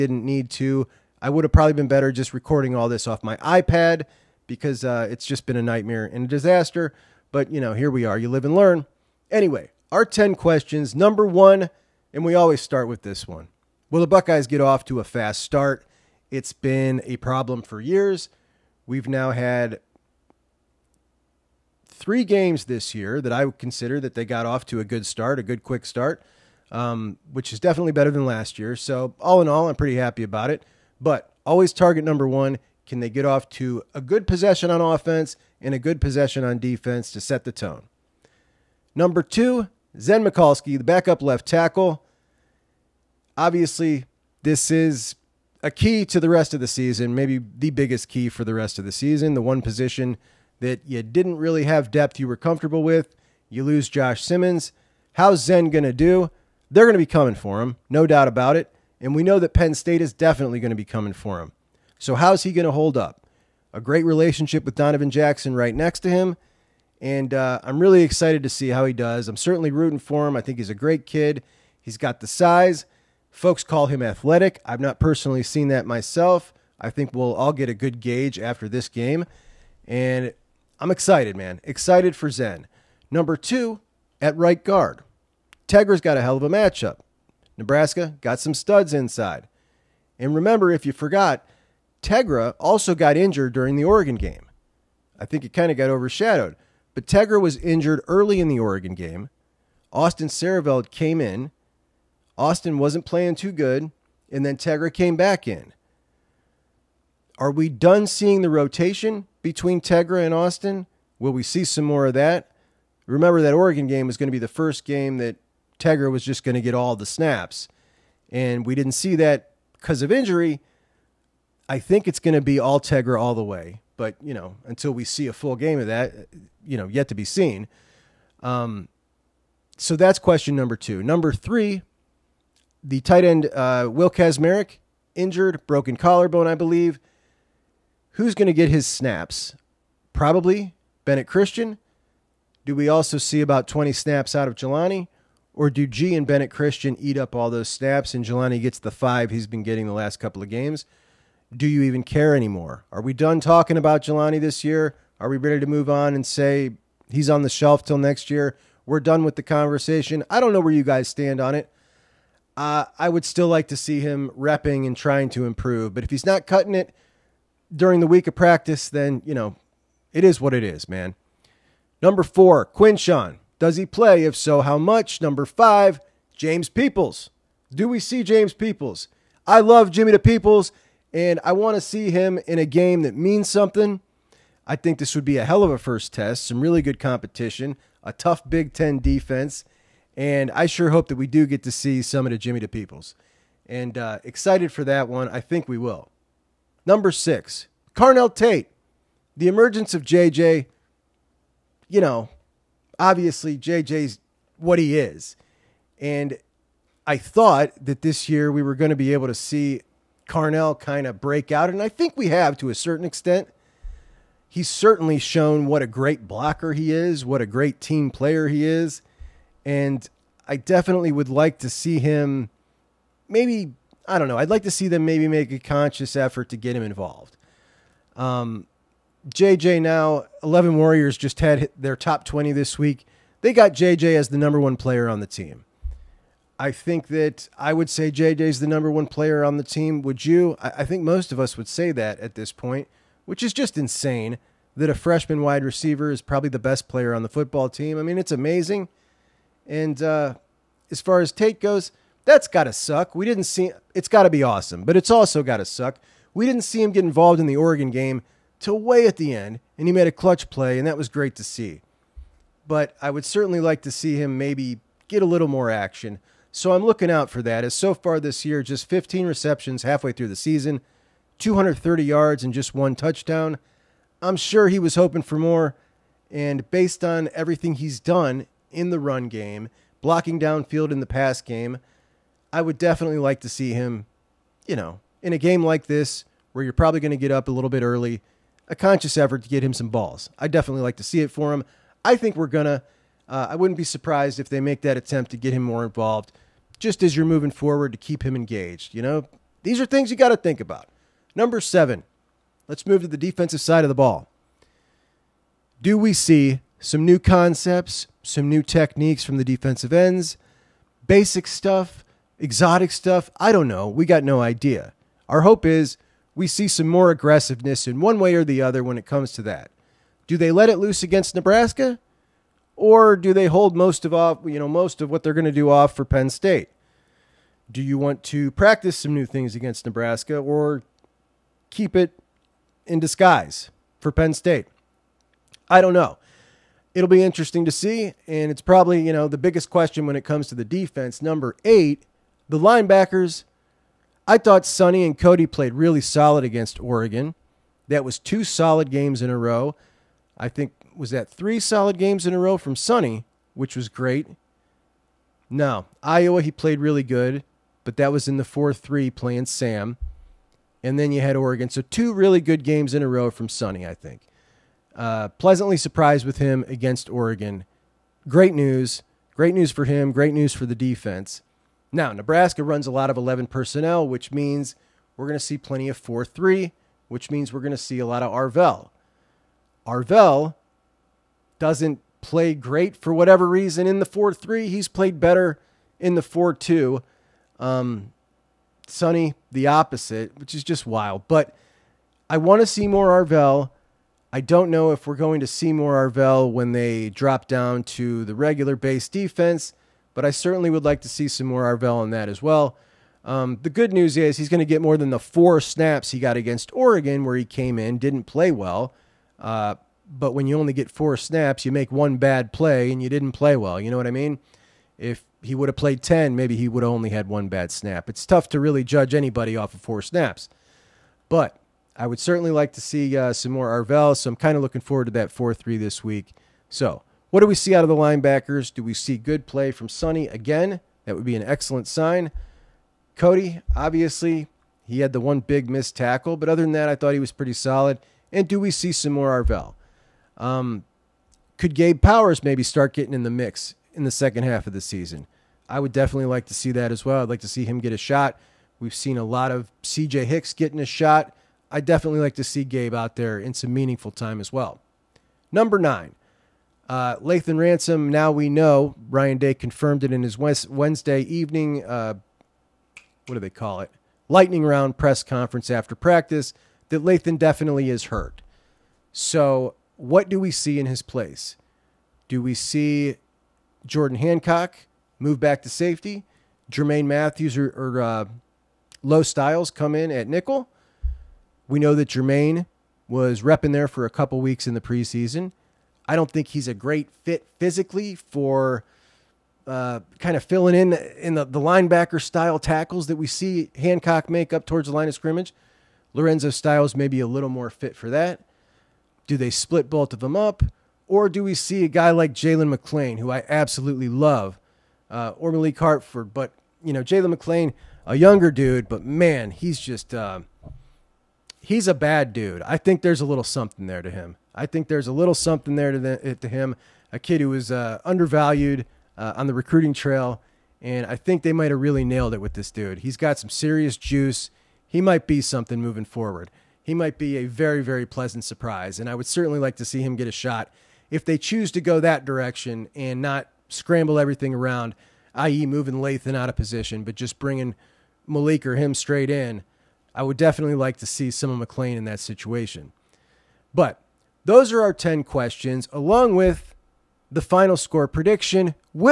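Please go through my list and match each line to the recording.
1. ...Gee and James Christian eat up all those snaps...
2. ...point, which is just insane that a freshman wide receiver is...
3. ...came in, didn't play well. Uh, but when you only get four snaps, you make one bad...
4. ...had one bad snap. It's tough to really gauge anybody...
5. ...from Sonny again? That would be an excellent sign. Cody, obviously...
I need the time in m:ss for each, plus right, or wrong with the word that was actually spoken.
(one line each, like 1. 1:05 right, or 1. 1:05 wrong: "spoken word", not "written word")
1. 2:25 wrong: "Bennett", not "James"
2. 4:02 right
3. 6:47 right
4. 6:57 wrong: "judge", not "gauge"
5. 7:09 right.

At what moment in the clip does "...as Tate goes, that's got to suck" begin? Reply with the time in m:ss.
4:11.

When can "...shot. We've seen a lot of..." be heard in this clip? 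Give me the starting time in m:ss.
7:27.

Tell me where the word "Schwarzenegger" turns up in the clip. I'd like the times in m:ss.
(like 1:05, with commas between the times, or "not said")
not said.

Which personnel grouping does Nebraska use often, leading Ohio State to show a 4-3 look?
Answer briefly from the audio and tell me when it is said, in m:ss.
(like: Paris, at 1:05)
11 personnel, at 6:13.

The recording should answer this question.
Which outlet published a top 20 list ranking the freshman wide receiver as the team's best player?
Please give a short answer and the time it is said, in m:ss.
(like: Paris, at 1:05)
11 Warriors, at 3:50.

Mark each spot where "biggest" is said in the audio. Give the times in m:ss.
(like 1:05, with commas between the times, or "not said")
0:47, 5:39.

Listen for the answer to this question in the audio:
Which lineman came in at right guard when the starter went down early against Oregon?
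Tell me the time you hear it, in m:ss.
1:39.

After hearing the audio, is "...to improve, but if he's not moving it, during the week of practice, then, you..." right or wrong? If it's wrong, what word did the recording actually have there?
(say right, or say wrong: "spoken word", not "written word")
wrong: "cutting", not "moving".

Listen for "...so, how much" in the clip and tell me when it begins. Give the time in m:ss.
2:54.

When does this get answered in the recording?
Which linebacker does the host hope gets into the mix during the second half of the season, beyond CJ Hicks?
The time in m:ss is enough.
7:21.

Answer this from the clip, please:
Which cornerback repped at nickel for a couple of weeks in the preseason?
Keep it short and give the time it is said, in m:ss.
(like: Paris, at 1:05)
Jermaine Matthews, at 7:56.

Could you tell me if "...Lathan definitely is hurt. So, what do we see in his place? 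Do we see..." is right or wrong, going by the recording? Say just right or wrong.
right.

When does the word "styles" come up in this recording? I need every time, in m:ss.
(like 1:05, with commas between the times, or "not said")
7:59, 8:12, 8:16.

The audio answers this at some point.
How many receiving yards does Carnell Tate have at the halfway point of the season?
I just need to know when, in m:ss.
4:31.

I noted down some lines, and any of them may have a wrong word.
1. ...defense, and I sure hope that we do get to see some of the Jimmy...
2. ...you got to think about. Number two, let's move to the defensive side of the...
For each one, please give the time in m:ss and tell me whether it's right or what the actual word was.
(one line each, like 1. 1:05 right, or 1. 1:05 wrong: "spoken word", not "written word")
1. 3:08 right
2. 5:00 wrong: "seven", not "two".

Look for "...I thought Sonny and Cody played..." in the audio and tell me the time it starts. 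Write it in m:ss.
5:44.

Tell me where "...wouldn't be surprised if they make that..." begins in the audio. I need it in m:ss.
4:53.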